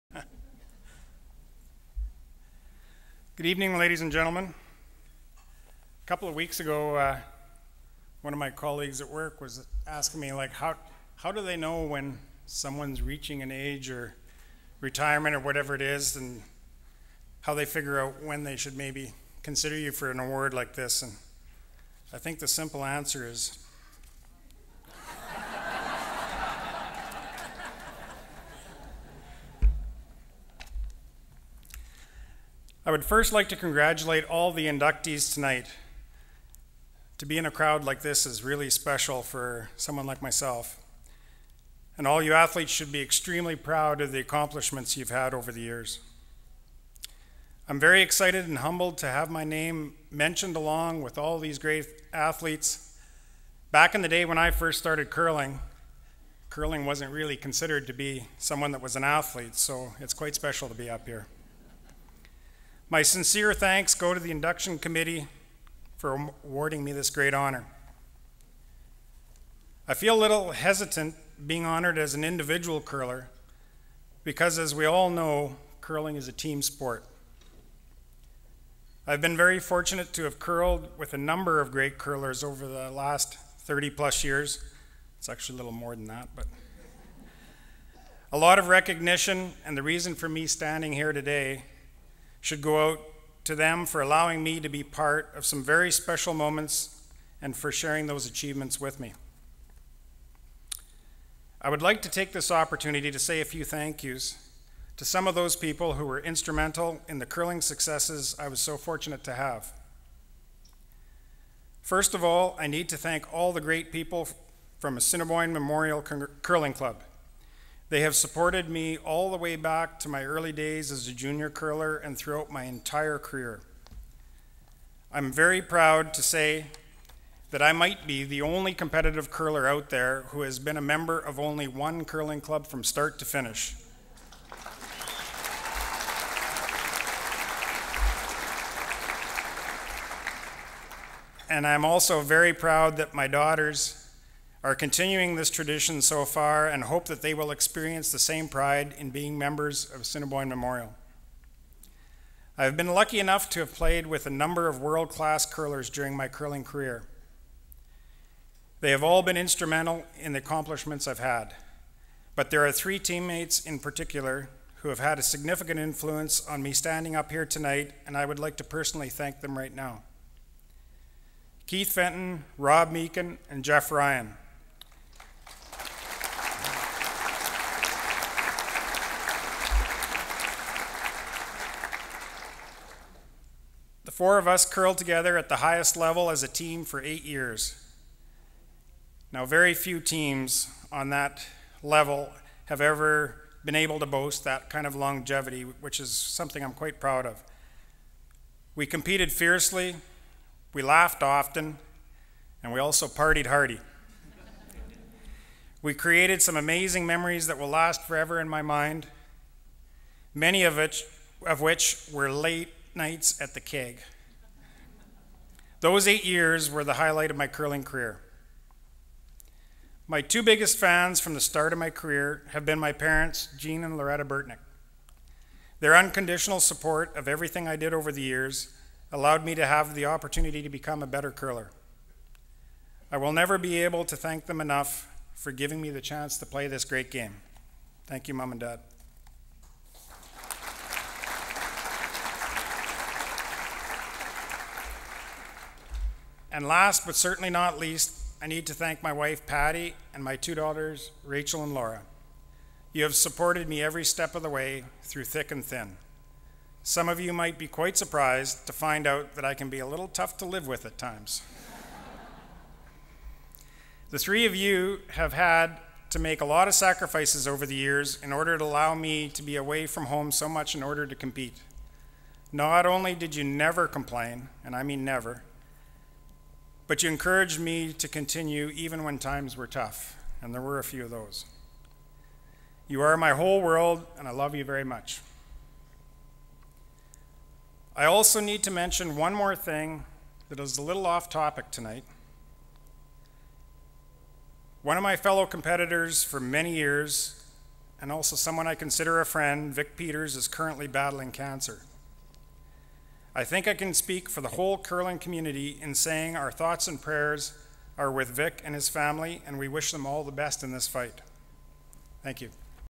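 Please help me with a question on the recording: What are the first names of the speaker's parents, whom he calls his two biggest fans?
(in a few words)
Jean and Loretta.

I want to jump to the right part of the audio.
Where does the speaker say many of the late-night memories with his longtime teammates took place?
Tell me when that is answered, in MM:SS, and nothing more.
03:33.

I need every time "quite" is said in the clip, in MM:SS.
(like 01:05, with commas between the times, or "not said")
01:00, 03:16, 04:17.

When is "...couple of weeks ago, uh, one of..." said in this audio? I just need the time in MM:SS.
00:06.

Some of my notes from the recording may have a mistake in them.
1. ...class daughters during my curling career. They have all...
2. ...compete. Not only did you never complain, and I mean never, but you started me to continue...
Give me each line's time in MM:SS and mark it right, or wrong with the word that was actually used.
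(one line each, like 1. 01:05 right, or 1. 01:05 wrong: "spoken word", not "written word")
1. 02:35 wrong: "curlers", not "daughters"
2. 04:31 wrong: "encouraged", not "started".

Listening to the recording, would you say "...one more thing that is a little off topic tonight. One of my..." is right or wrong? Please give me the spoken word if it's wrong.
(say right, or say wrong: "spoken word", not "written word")
right.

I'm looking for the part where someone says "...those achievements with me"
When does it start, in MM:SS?
01:38.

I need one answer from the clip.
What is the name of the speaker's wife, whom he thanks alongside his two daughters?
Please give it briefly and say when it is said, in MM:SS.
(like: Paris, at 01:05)
Patty, at 04:09.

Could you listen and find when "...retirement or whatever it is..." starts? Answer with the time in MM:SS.
00:14.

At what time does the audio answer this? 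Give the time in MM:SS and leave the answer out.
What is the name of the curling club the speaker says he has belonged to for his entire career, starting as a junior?
01:54.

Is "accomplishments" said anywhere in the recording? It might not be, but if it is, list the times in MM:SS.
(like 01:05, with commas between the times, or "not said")
00:44, 02:40.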